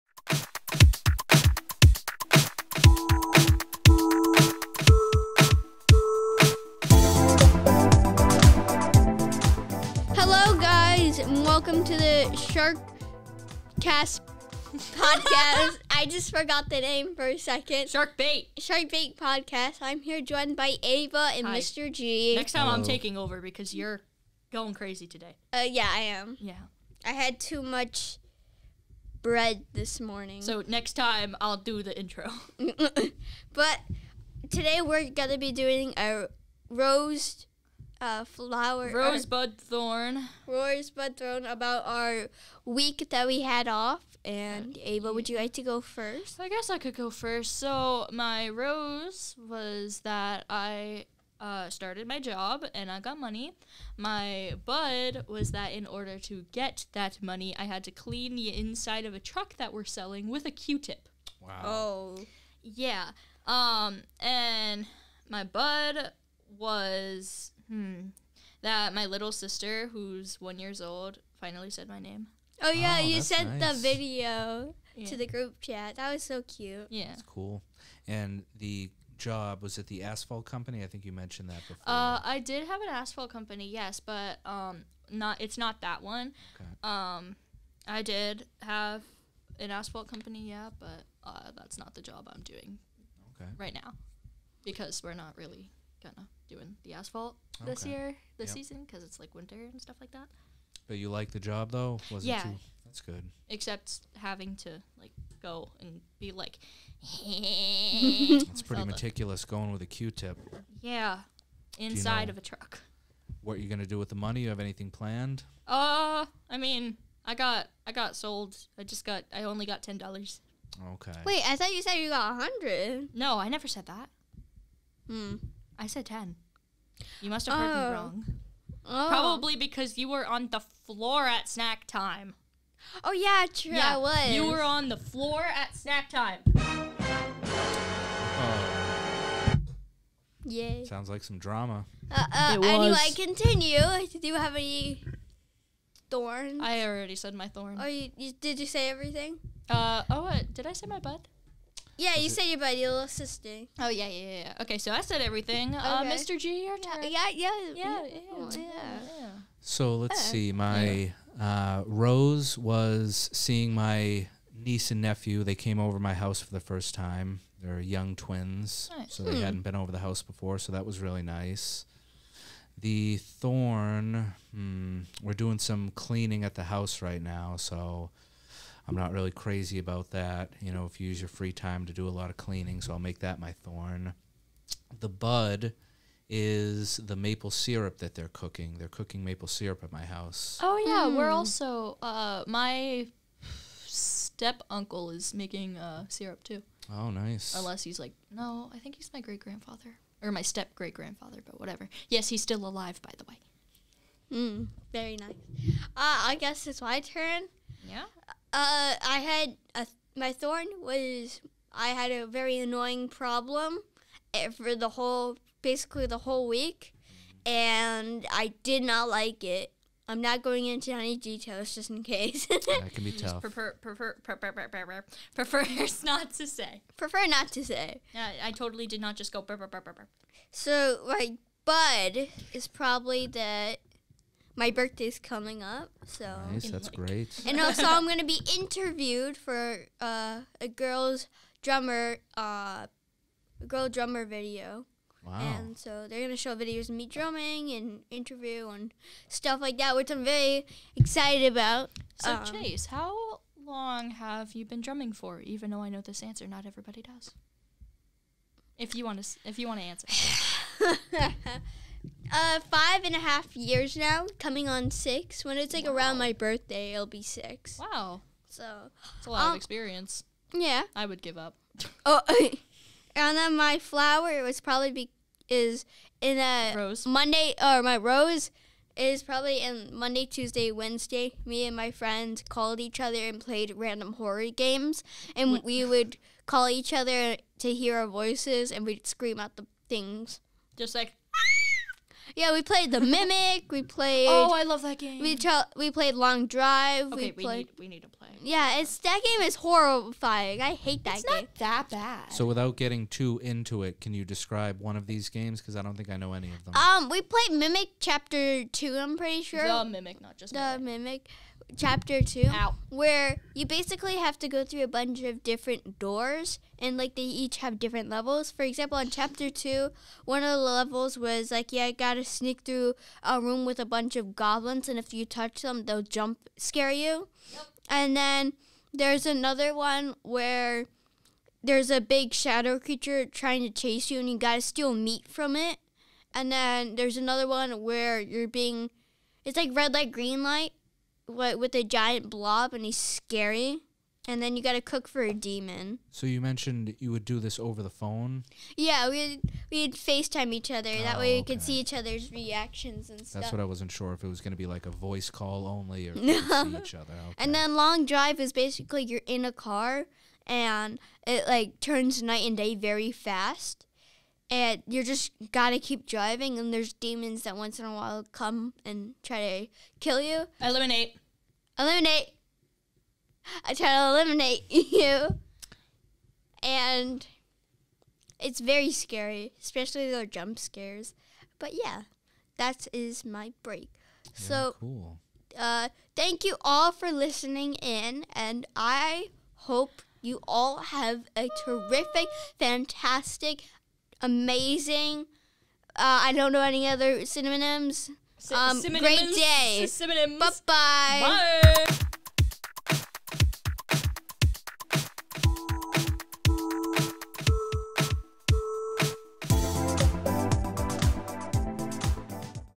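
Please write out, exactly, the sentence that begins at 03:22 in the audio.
Yes, he's still alive, by the way.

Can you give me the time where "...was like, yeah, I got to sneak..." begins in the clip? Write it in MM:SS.
05:21.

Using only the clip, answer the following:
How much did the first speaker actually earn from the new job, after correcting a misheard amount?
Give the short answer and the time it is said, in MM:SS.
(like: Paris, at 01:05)
$10, at 01:59.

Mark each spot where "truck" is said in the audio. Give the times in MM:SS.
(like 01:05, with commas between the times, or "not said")
00:59, 01:52.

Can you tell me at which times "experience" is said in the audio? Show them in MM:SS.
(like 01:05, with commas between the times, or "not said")
04:29.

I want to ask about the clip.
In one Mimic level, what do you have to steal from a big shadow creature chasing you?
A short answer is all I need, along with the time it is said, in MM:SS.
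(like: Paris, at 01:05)
Meat, at 05:34.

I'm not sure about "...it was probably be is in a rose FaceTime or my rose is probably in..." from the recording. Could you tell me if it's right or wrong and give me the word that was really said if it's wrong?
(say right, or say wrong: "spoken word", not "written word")
wrong: "Monday", not "FaceTime".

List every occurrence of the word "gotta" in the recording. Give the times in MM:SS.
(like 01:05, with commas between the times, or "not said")
05:34, 06:05.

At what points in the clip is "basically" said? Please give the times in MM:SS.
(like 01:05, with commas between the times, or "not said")
03:35, 05:13, 05:58.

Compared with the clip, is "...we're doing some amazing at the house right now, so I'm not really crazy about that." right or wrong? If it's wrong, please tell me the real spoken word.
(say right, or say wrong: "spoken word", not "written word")
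wrong: "cleaning", not "amazing".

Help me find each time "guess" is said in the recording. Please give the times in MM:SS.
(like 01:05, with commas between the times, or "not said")
00:46, 03:26.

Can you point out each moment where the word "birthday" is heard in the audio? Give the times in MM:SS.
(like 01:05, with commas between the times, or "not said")
03:54, 04:26.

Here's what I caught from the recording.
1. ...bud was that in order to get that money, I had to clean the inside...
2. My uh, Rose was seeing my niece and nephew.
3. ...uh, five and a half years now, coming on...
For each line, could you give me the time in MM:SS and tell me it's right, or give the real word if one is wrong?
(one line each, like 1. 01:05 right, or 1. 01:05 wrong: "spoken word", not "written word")
1. 00:54 right
2. 02:40 right
3. 04:22 right.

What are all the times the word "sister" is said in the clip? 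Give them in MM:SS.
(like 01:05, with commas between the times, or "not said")
01:09, 02:33.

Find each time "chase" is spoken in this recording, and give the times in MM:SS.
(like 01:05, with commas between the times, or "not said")
04:12, 05:33.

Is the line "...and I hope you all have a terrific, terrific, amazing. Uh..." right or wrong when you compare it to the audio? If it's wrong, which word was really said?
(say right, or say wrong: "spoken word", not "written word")
wrong: "fantastic", not "terrific".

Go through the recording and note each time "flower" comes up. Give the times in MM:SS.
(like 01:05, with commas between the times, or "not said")
00:38, 04:33.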